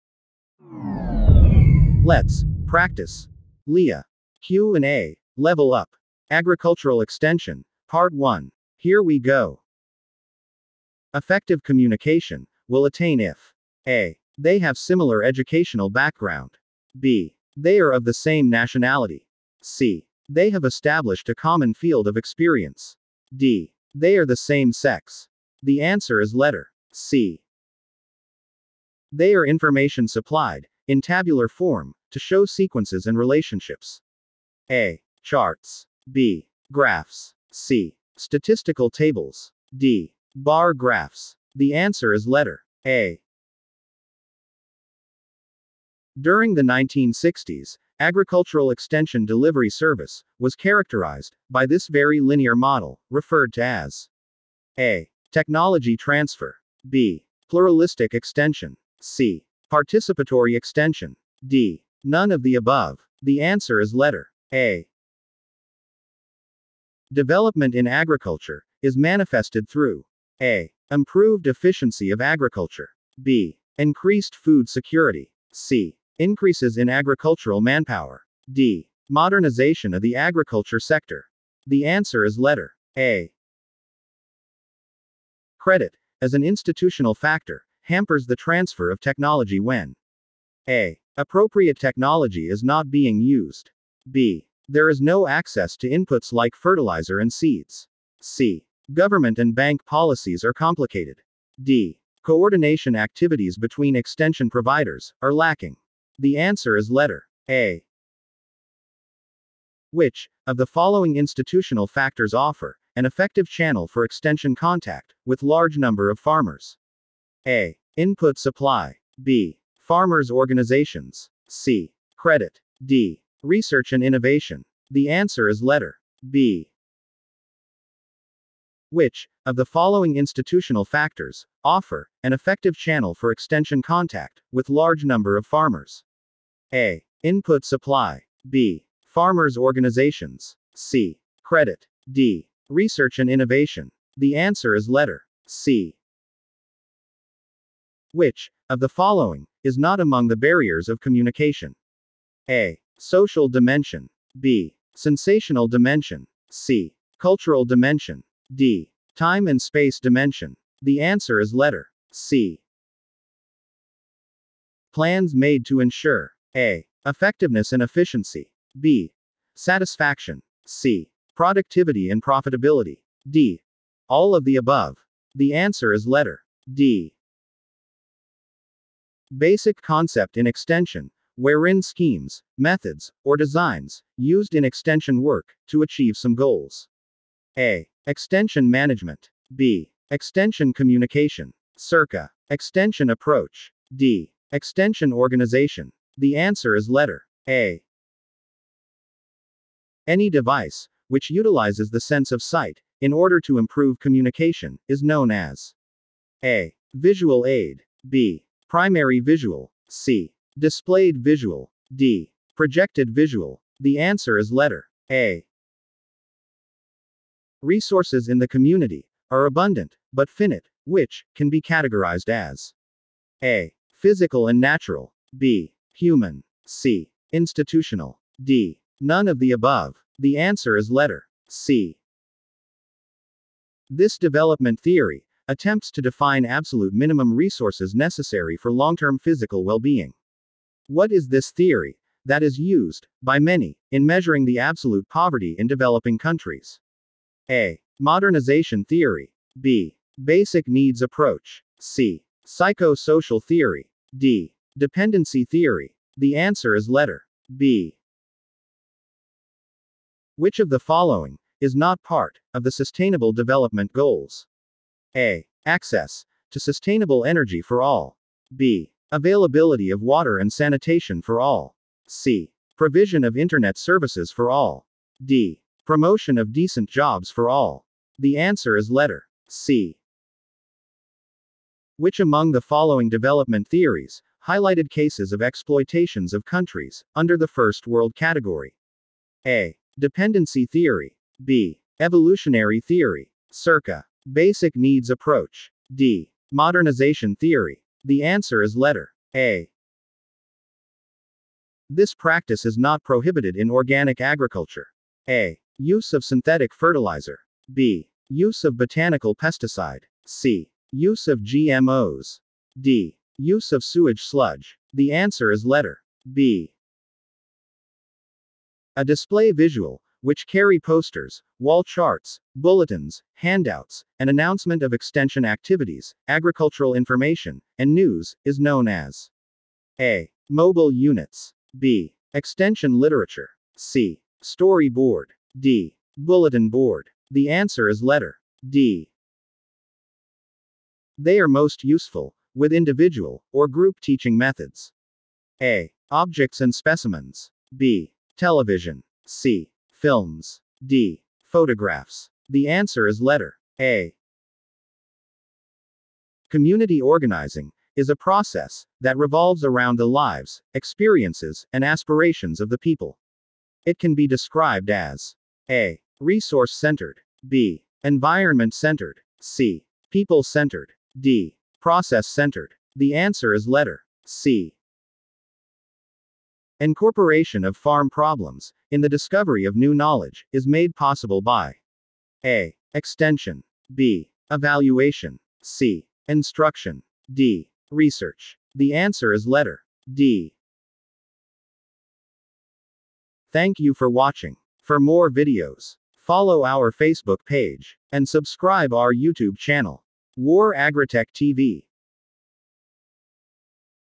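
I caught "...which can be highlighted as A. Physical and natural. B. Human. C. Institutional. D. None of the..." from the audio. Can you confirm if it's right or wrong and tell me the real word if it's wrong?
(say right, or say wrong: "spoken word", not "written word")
wrong: "categorized", not "highlighted".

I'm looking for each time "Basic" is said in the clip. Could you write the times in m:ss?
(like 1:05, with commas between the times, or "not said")
2:59, 4:10, 4:54.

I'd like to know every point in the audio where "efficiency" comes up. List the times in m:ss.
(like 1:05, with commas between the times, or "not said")
1:11, 2:47.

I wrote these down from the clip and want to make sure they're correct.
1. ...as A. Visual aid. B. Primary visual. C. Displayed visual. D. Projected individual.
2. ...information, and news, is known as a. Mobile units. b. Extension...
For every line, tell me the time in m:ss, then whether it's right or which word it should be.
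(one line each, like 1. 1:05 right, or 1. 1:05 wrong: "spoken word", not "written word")
1. 3:25 wrong: "visual", not "individual"
2. 5:26 right.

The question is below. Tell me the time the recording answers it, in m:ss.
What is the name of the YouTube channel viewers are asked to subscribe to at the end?
6:40.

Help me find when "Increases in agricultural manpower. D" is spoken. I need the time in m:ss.
1:16.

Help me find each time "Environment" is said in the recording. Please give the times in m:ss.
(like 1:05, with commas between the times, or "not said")
6:08.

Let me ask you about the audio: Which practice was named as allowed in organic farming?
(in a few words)
Use of botanical pesticide.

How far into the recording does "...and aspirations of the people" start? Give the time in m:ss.
6:01.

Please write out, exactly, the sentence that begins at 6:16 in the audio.
Incorporation of farm problems in the discovery of new knowledge is made possible by A.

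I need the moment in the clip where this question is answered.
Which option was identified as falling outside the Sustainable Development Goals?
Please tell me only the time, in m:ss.
4:32.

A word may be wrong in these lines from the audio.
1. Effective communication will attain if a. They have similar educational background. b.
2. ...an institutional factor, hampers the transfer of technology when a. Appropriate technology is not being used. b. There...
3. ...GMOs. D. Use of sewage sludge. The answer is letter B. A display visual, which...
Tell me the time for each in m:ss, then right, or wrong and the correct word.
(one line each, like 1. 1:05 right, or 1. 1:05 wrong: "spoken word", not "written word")
1. 0:11 right
2. 1:26 right
3. 5:11 right.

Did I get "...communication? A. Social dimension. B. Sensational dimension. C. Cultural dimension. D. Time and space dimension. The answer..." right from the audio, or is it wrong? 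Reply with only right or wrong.
right.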